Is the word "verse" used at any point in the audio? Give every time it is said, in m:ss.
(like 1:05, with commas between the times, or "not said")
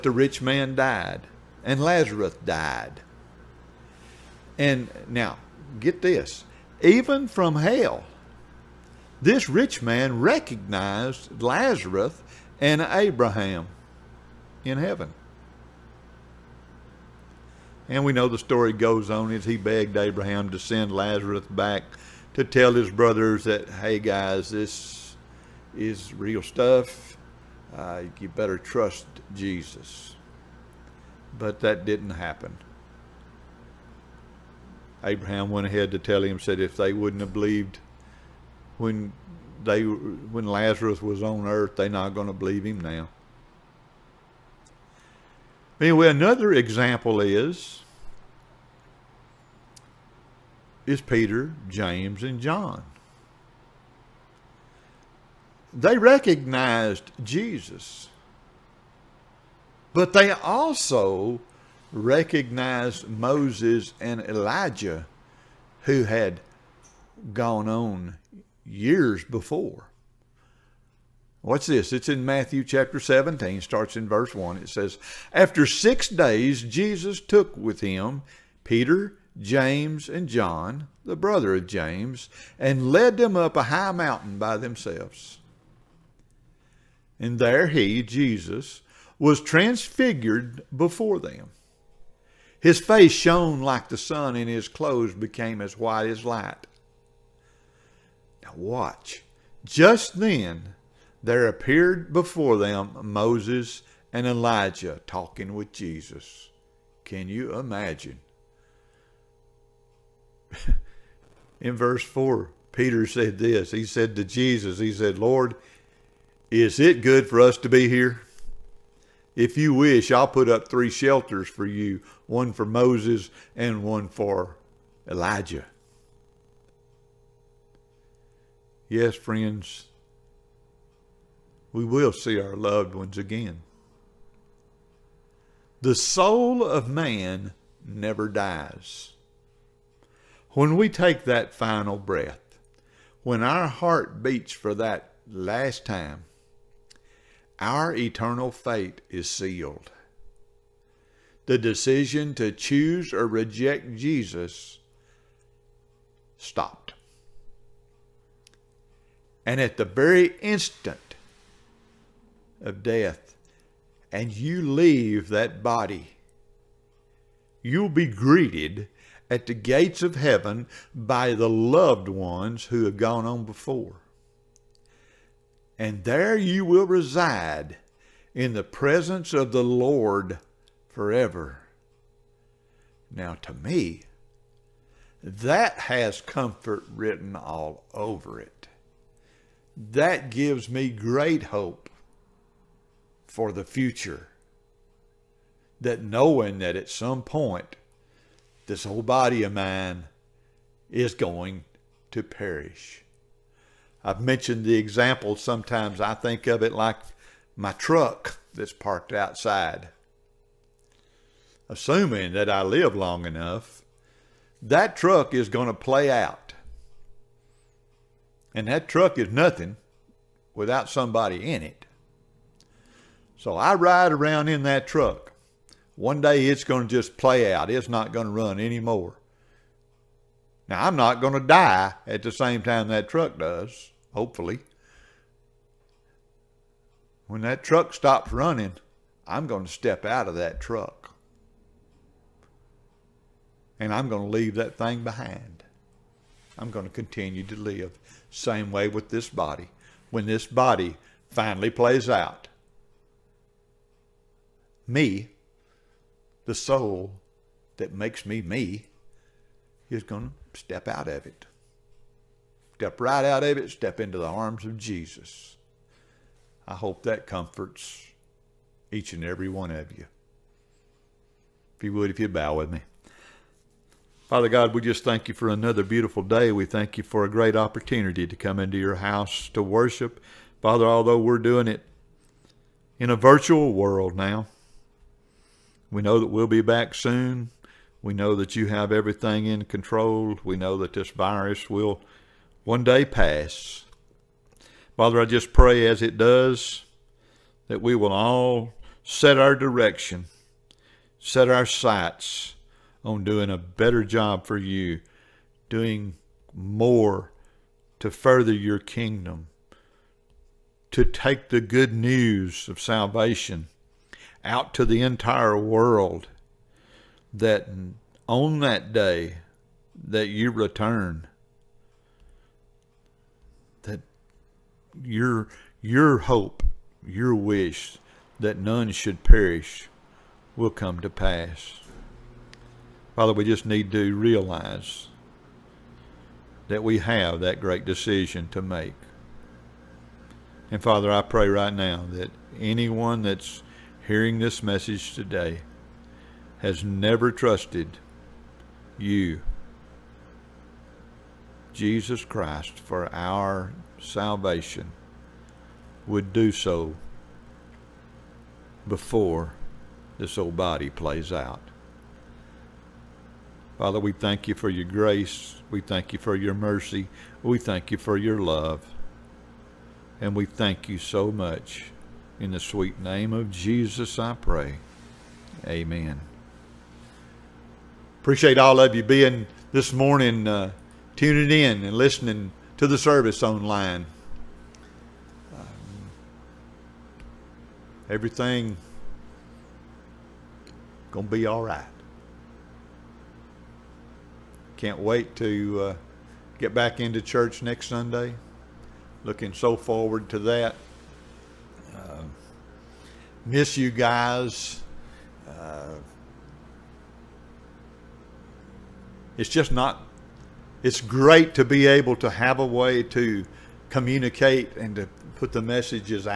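1:14, 1:51.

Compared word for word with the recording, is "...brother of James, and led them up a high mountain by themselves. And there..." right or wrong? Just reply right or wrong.
right.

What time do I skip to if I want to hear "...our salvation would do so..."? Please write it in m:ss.
5:53.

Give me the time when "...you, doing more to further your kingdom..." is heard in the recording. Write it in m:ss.
5:04.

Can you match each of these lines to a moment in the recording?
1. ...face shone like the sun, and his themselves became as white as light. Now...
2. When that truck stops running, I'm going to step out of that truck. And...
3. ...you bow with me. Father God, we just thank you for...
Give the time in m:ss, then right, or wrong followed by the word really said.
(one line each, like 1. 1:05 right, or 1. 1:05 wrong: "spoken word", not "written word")
1. 1:32 wrong: "clothes", not "themselves"
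2. 3:57 right
3. 4:32 right.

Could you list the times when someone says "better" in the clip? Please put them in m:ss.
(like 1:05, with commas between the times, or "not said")
0:28, 5:03.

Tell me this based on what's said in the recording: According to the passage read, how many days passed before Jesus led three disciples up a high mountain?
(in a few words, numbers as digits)
6.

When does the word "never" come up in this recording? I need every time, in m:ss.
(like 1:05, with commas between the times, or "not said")
2:17, 5:46.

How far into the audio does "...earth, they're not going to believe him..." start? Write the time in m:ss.
0:41.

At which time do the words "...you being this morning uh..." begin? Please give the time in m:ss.
6:18.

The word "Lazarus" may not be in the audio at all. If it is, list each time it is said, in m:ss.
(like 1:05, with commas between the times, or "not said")
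0:01, 0:11, 0:20, 0:40.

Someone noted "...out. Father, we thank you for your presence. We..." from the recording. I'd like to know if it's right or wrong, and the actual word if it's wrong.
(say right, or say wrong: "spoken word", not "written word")
wrong: "grace", not "presence".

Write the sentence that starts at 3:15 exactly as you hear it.
That knowing that at some point, this whole body of mine is going to perish.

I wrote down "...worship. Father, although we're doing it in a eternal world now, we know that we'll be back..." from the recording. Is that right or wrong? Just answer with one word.
wrong.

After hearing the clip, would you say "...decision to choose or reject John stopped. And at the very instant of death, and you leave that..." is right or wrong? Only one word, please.
wrong.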